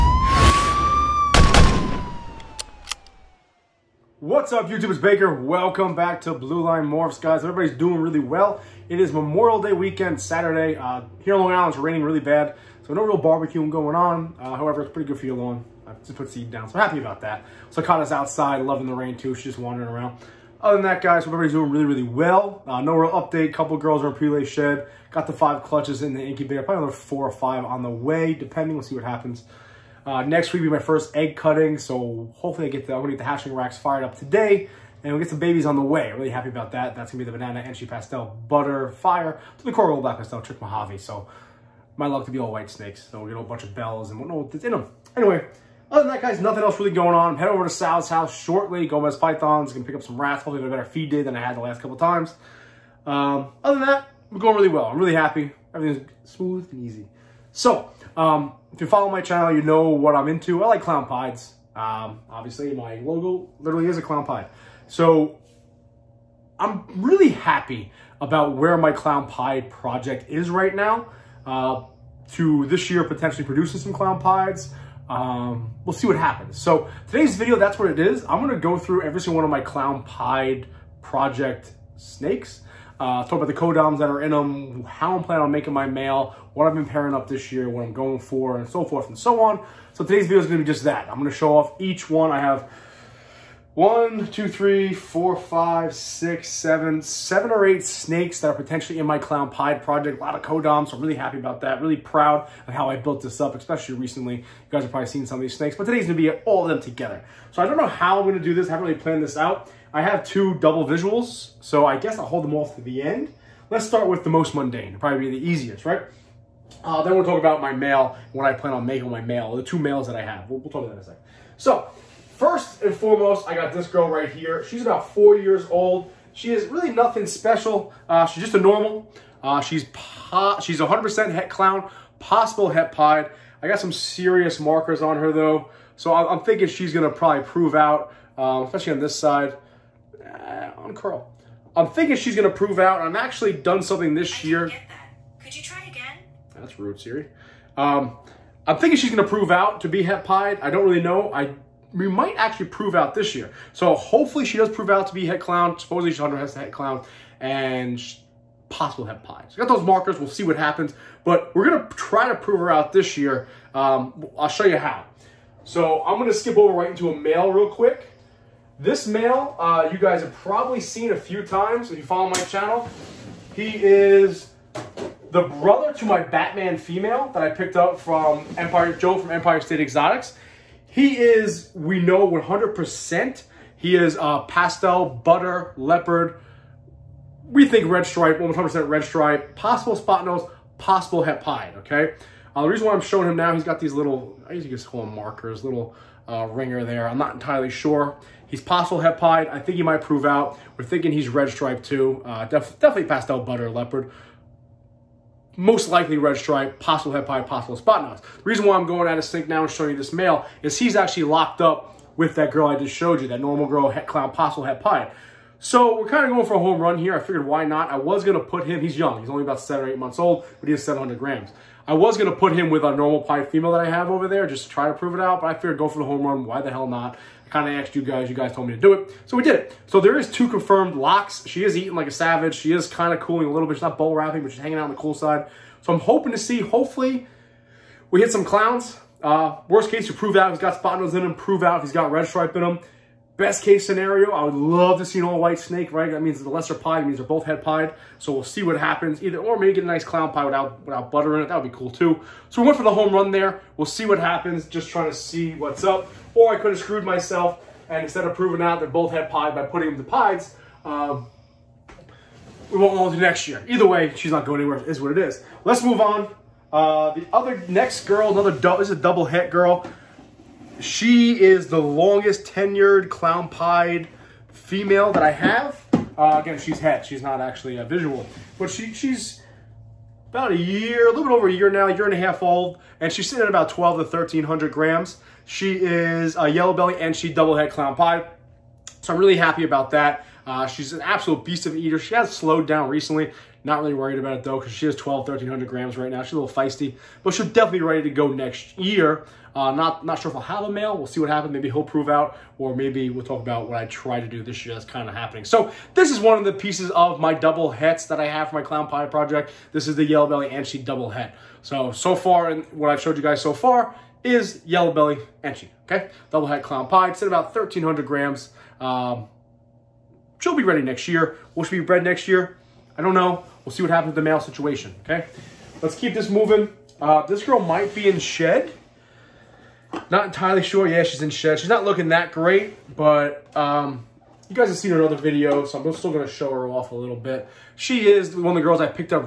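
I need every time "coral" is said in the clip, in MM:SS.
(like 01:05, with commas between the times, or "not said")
00:39.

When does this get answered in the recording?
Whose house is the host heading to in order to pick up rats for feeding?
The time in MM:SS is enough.
00:47.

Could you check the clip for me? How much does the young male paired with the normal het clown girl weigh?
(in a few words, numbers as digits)
700 grams.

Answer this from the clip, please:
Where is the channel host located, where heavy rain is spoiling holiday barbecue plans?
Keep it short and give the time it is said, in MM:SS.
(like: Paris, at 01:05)
Long Island, at 00:11.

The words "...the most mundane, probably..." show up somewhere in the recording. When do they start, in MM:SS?
01:54.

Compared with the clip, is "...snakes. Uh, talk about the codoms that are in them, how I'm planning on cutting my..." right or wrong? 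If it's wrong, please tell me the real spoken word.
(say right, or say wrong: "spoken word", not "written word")
wrong: "making", not "cutting".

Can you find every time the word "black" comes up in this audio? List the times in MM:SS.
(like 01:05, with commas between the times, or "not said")
00:39.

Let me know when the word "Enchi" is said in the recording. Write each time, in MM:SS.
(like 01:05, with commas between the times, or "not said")
05:10, 05:15.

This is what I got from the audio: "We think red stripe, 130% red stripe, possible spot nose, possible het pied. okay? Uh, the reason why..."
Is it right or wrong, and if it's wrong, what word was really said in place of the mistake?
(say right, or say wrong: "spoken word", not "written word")
wrong: "100", not "130".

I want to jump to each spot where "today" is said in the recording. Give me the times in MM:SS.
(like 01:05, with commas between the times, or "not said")
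00:34, 01:17, 01:30, 01:45.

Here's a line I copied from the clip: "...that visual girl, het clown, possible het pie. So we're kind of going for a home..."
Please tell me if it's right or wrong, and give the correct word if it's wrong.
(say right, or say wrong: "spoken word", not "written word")
wrong: "normal", not "visual".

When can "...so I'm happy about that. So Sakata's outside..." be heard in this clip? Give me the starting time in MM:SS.
00:16.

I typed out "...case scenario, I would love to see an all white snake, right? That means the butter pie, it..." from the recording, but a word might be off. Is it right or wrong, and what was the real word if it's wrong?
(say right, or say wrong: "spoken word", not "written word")
wrong: "lesser", not "butter".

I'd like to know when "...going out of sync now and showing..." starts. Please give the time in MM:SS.
03:28.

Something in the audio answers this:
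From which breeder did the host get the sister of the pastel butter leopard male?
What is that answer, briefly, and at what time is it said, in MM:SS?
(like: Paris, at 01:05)
Empire Joe, at 02:58.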